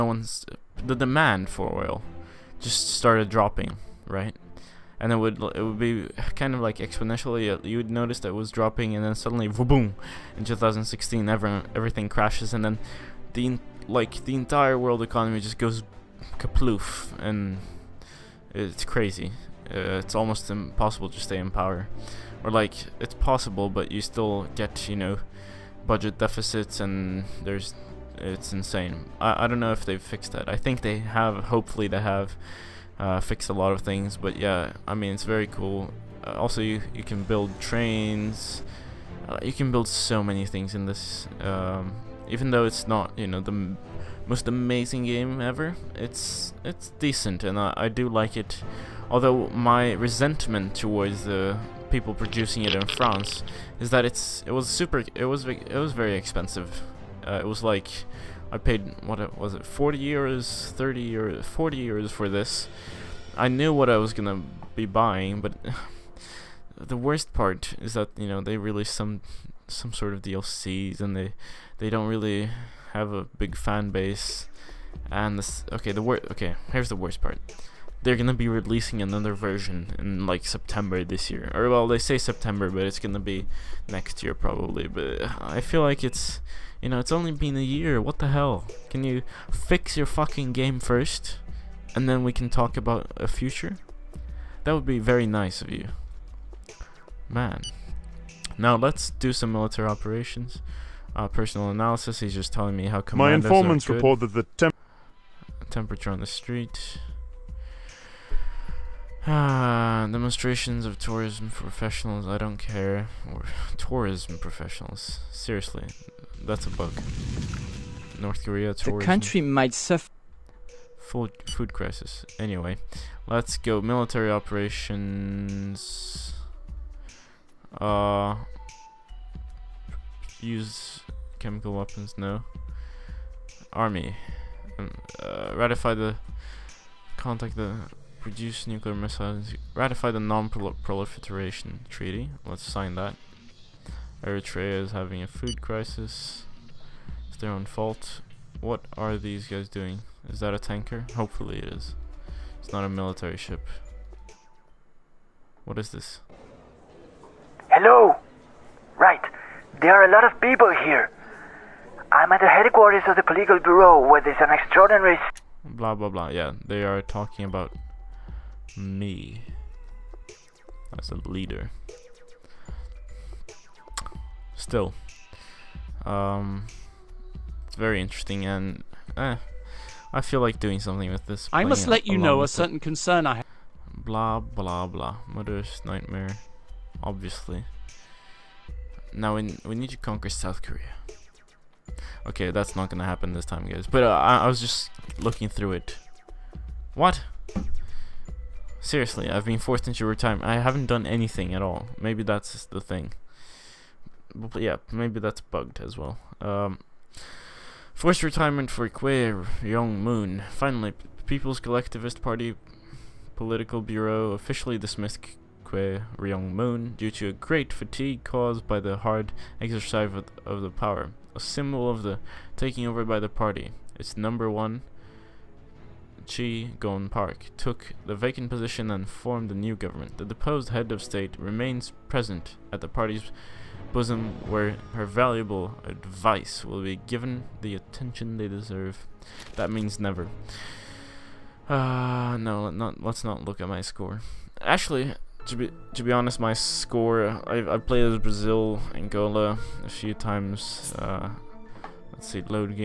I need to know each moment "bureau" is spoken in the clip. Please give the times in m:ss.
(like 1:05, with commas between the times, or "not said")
2:43, 3:33.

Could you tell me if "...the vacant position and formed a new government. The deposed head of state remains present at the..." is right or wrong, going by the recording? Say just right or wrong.
right.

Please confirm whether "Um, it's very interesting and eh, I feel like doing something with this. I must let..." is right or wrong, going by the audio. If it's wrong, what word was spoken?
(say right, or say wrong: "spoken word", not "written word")
right.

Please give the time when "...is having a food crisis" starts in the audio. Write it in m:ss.
2:24.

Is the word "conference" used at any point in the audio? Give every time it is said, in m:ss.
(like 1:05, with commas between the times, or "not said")
not said.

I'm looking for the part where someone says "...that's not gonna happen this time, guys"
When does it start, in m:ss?
3:12.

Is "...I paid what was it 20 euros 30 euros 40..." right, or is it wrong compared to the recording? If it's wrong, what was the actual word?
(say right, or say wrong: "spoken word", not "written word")
wrong: "40", not "20".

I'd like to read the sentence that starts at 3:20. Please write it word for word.
I haven't done anything at all.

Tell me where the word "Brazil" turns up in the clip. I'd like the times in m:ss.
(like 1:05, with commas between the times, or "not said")
4:08.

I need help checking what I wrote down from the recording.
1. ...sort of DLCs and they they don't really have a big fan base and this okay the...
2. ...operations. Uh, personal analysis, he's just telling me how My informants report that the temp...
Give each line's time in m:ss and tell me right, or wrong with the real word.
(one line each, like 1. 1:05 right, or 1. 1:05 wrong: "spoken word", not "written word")
1. 1:09 right
2. 1:39 right.